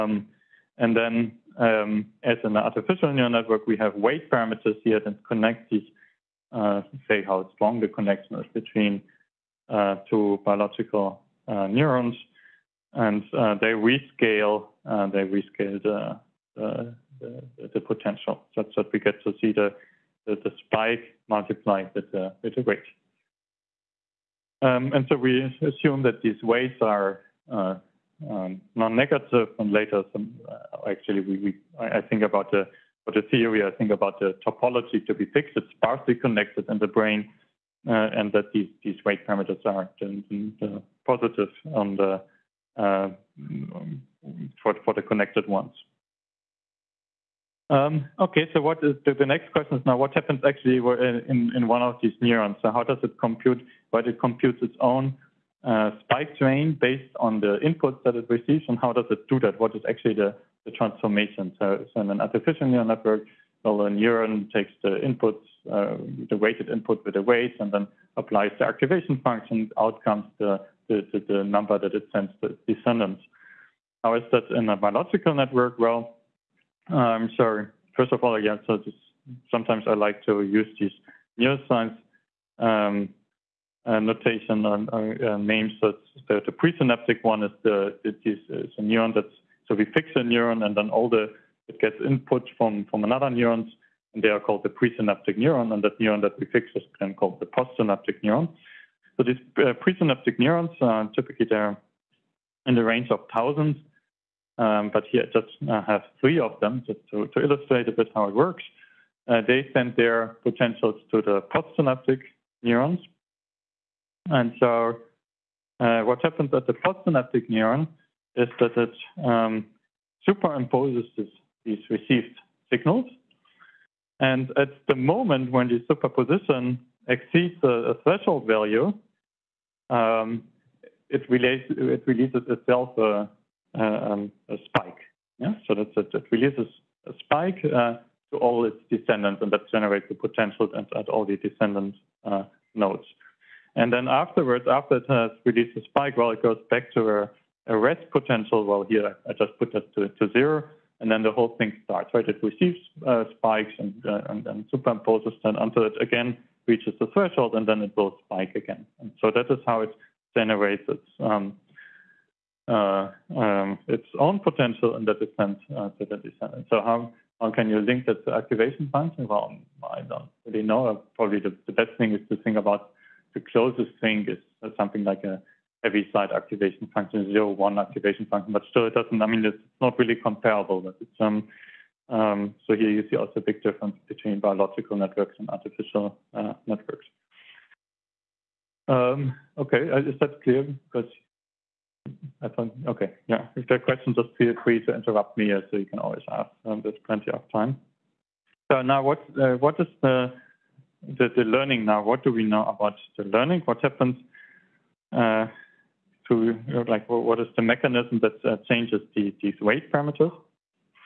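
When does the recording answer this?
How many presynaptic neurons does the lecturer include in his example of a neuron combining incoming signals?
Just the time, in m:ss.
1:46.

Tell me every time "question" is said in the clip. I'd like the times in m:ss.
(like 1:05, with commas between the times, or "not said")
0:49, 3:13.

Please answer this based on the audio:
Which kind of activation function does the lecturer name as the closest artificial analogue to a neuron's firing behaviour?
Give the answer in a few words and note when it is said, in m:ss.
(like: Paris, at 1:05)
Heaviside, at 2:55.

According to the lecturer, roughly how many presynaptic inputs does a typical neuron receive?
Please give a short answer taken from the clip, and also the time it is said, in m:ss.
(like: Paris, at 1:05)
thousands, at 1:43.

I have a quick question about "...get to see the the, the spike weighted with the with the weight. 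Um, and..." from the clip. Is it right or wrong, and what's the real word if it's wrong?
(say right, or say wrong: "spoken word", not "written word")
wrong: "multiplied", not "weighted".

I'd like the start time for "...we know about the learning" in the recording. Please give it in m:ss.
3:22.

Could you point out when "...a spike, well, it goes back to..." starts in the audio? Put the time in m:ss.
2:25.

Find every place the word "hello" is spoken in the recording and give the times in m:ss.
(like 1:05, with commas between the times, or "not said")
not said.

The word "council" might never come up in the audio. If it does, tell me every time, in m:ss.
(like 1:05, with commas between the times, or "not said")
not said.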